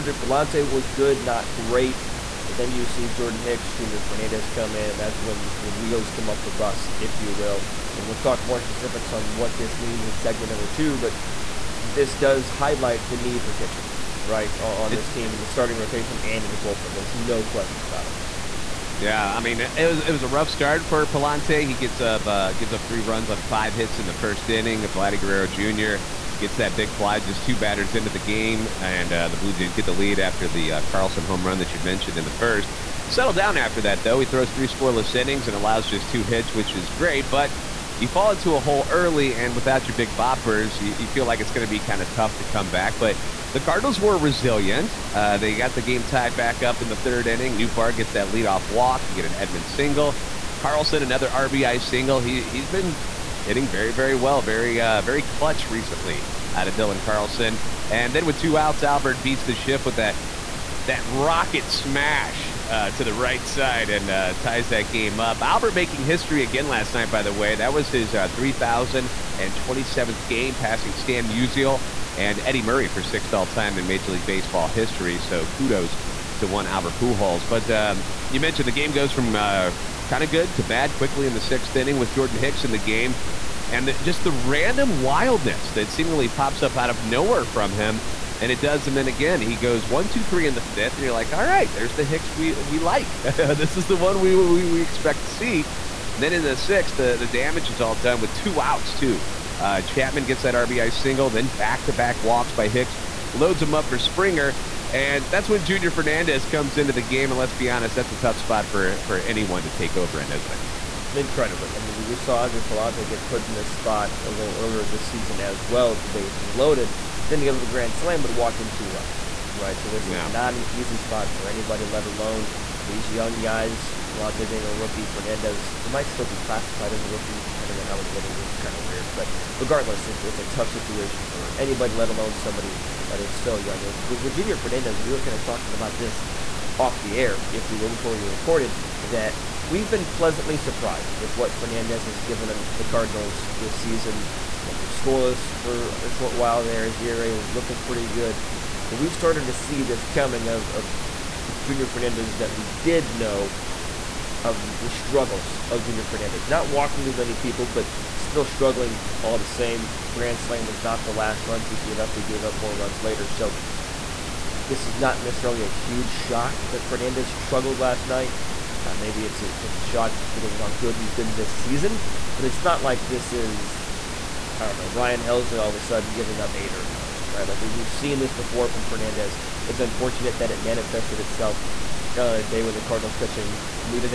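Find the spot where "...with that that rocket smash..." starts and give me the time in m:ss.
0:59.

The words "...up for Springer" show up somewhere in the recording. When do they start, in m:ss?
1:43.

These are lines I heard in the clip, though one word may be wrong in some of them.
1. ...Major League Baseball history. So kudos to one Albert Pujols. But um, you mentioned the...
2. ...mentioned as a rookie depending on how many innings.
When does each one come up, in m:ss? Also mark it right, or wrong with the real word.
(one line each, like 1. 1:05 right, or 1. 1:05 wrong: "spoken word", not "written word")
1. 1:13 right
2. 2:06 wrong: "classified", not "mentioned".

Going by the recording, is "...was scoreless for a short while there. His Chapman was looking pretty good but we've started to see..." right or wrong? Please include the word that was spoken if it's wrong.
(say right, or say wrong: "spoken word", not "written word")
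wrong: "ERA", not "Chapman".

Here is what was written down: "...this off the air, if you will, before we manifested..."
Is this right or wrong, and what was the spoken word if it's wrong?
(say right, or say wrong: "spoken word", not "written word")
wrong: "recorded", not "manifested".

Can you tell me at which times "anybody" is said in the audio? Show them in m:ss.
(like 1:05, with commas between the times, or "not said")
2:01, 2:11.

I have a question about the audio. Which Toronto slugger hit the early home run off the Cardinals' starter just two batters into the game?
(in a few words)
Vladdy Guerrero Jr.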